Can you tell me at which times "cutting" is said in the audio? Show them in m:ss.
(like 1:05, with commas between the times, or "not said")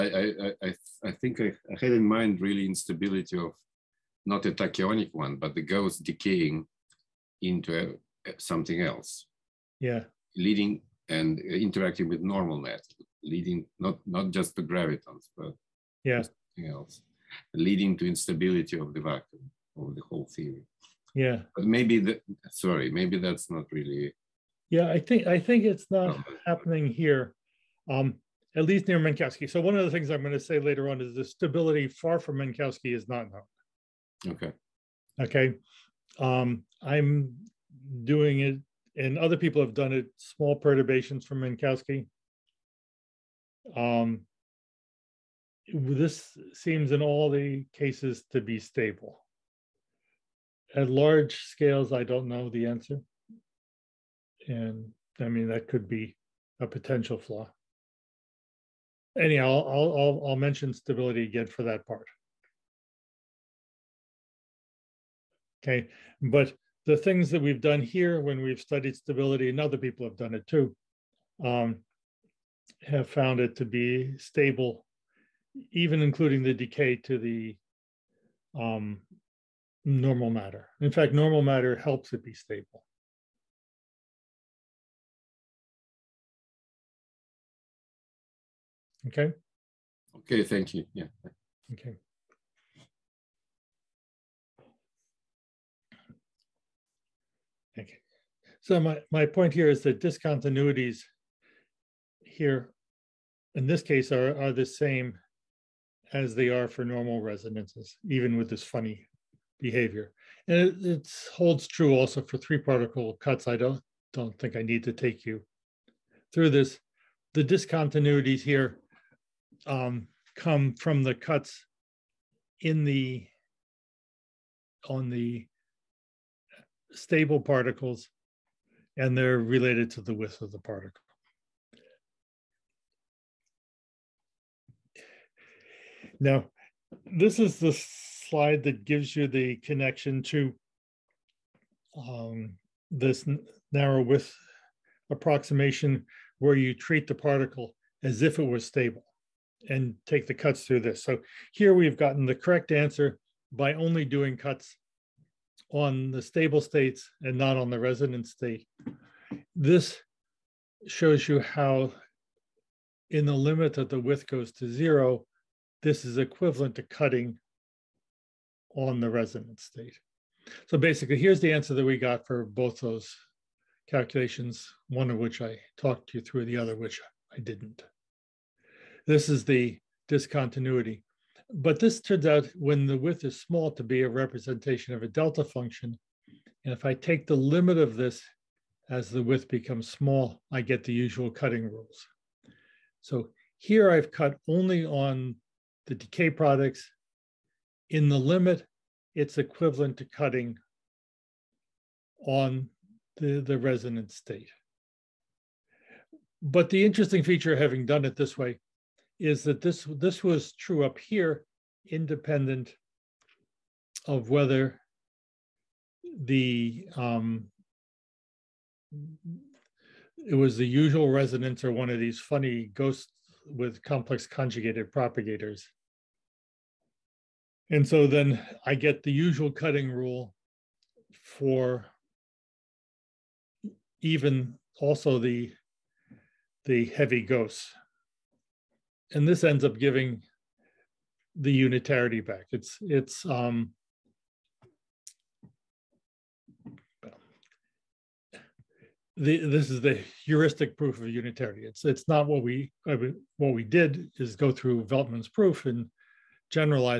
2:46, 3:11, 3:20, 3:49.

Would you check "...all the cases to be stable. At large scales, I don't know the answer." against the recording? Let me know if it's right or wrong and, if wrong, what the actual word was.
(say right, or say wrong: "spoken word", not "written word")
right.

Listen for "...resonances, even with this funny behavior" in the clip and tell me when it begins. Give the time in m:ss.
1:47.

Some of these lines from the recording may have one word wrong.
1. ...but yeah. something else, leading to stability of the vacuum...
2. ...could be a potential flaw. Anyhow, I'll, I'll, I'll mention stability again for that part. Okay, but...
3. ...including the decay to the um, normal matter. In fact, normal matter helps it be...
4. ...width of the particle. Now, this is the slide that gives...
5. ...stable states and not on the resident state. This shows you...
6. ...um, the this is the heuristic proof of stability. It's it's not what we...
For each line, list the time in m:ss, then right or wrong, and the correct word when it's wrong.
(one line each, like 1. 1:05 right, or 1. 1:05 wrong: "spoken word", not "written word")
1. 0:15 wrong: "instability", not "stability"
2. 0:55 right
3. 1:16 right
4. 2:10 right
5. 2:36 right
6. 4:03 wrong: "unitarity", not "stability".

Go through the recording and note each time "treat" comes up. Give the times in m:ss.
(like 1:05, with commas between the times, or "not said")
2:26.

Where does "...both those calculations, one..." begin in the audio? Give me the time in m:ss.
2:52.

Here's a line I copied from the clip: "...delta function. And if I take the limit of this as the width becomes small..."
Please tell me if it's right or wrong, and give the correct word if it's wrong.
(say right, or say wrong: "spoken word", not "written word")
right.